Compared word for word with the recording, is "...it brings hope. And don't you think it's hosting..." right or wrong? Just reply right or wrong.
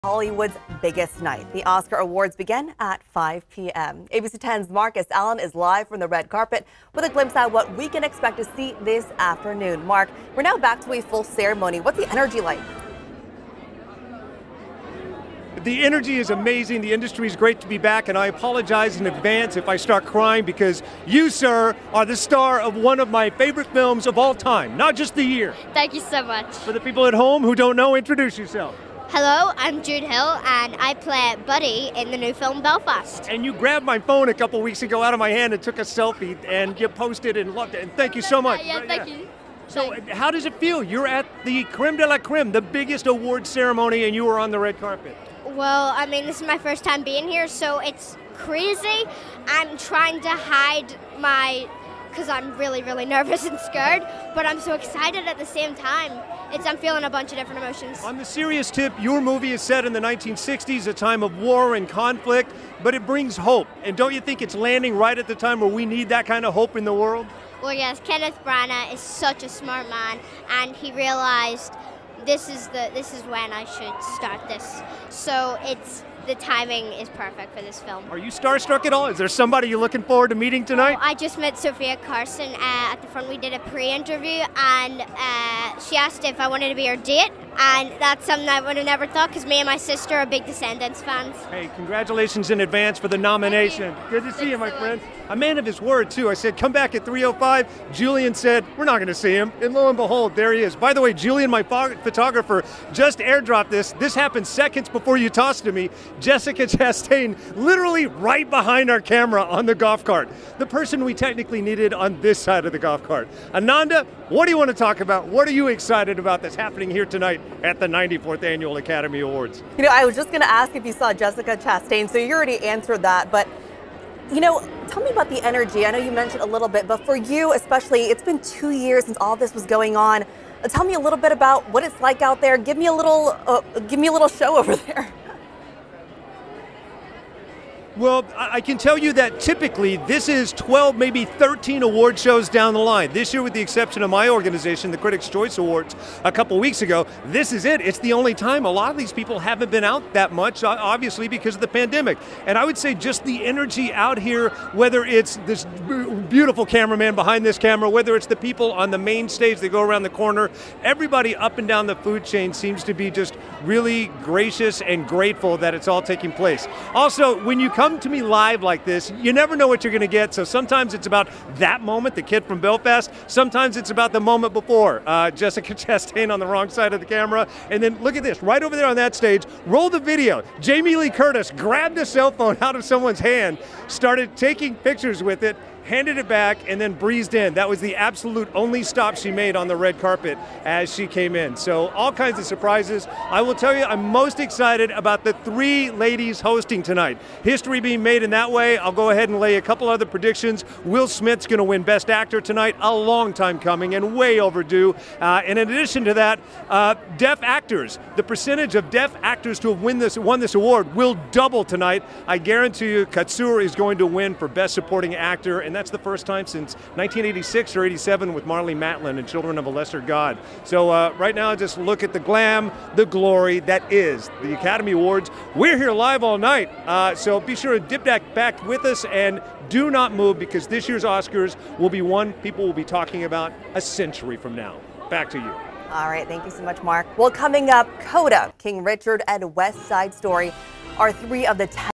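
wrong.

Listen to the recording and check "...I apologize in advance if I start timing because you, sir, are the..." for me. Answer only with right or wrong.
wrong.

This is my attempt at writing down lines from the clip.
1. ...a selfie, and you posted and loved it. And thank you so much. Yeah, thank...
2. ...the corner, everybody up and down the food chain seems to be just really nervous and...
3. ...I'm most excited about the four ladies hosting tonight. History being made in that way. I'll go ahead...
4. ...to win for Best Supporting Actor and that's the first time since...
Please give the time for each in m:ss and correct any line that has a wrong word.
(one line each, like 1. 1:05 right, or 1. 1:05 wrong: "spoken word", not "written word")
1. 0:35 right
2. 2:40 wrong: "gracious", not "nervous"
3. 3:13 wrong: "three", not "four"
4. 3:33 right.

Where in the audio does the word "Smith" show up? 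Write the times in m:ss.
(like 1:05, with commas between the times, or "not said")
3:21.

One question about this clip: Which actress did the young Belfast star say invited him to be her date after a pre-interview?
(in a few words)
Sofia Carson.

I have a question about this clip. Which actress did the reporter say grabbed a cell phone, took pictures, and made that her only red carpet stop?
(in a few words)
Jamie Lee Curtis.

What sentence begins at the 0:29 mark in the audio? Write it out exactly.
Hello, I'm Jude Hill, and I play Buddy in the new film Belfast.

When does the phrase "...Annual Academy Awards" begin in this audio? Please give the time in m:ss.
1:58.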